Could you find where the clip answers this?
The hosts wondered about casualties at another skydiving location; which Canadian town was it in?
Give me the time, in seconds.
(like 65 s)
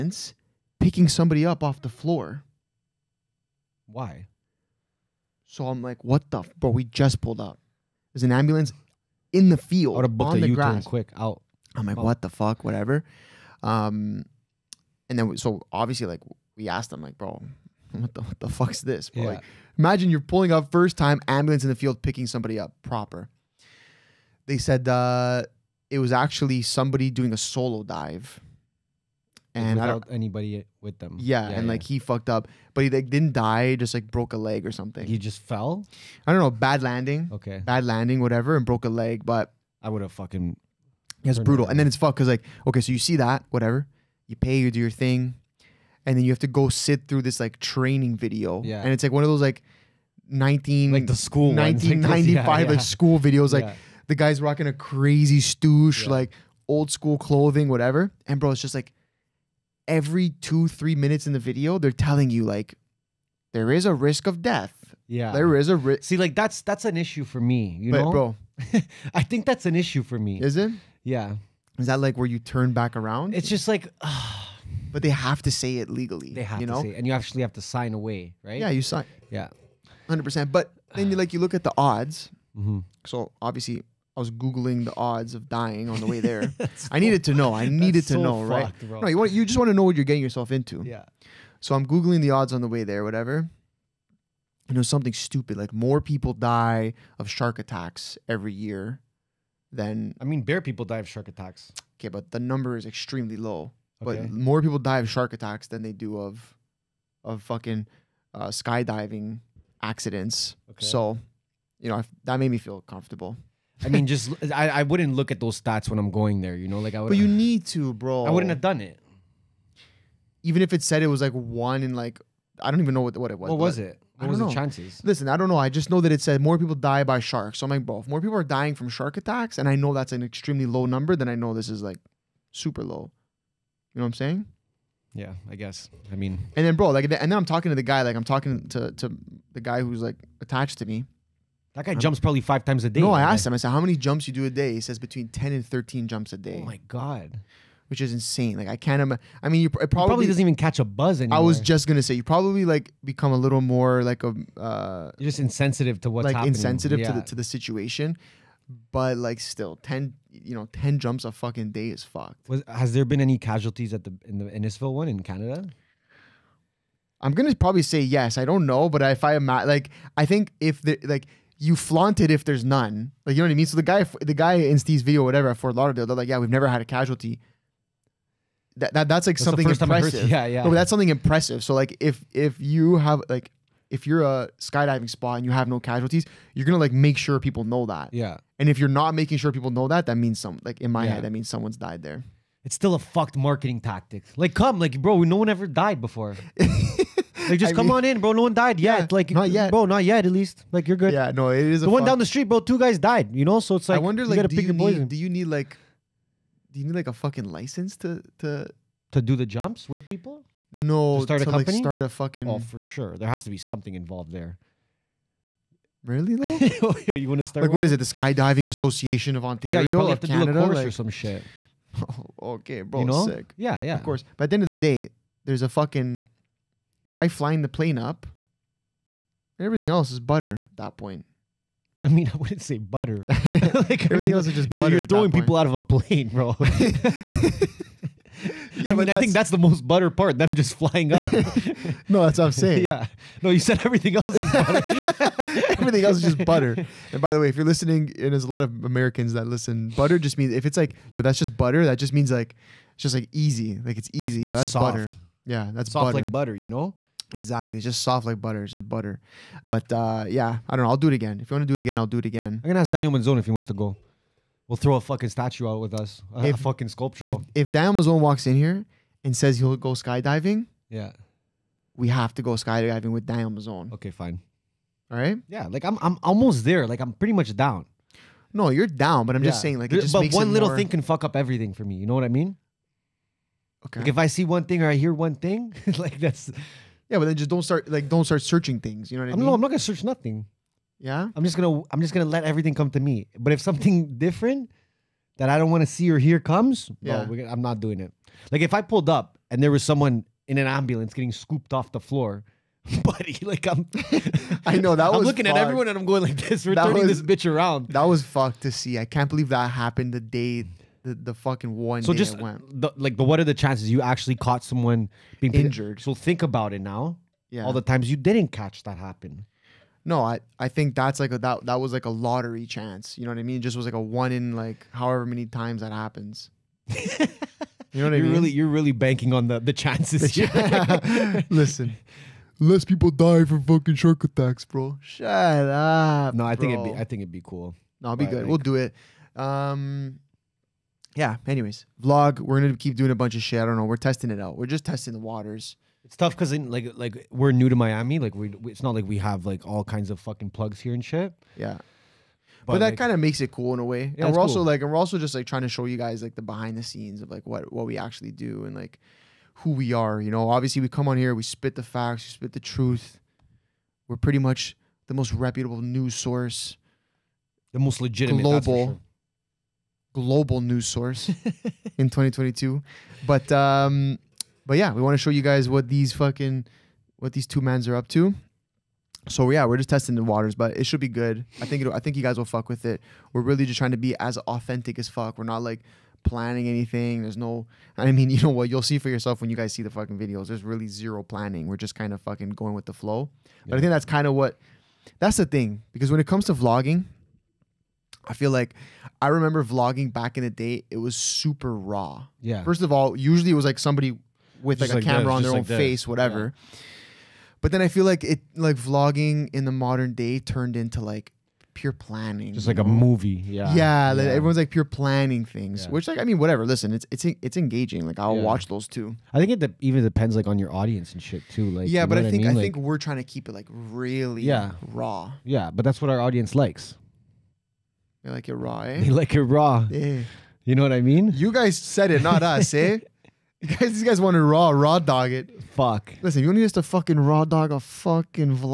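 164 s.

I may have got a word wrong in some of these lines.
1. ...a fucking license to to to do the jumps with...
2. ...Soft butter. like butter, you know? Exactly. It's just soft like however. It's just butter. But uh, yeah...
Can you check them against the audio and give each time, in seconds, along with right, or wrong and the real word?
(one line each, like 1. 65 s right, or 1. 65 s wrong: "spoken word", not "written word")
1. 207 s right
2. 255 s wrong: "butter", not "however".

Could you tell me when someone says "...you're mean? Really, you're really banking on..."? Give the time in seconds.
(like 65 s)
327 s.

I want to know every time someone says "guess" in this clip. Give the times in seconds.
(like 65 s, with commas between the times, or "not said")
135 s.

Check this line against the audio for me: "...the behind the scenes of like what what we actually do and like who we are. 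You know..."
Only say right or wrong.
right.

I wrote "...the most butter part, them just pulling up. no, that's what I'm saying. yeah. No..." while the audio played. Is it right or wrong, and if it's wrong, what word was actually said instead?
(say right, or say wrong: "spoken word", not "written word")
wrong: "flying", not "pulling".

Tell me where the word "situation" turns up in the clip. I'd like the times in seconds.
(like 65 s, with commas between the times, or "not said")
157 s.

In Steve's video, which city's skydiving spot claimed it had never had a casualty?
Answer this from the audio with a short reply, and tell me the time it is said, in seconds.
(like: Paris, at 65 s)
Fort Lauderdale, at 175 s.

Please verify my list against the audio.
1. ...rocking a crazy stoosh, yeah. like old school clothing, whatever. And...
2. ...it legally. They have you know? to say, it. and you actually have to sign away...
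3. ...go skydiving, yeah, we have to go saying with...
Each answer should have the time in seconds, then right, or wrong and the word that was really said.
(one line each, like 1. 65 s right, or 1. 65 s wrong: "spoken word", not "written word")
1. 54 s right
2. 75 s right
3. 269 s wrong: "skydiving", not "saying".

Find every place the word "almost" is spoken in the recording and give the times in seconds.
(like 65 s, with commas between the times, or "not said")
276 s.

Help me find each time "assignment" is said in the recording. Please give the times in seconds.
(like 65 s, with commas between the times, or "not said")
not said.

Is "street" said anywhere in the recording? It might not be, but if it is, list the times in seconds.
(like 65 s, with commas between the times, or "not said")
202 s.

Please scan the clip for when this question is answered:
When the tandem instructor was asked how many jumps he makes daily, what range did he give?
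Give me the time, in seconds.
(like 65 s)
144 s.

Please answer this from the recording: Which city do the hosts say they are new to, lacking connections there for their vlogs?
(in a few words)
Miami.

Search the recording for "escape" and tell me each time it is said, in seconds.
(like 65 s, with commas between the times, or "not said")
not said.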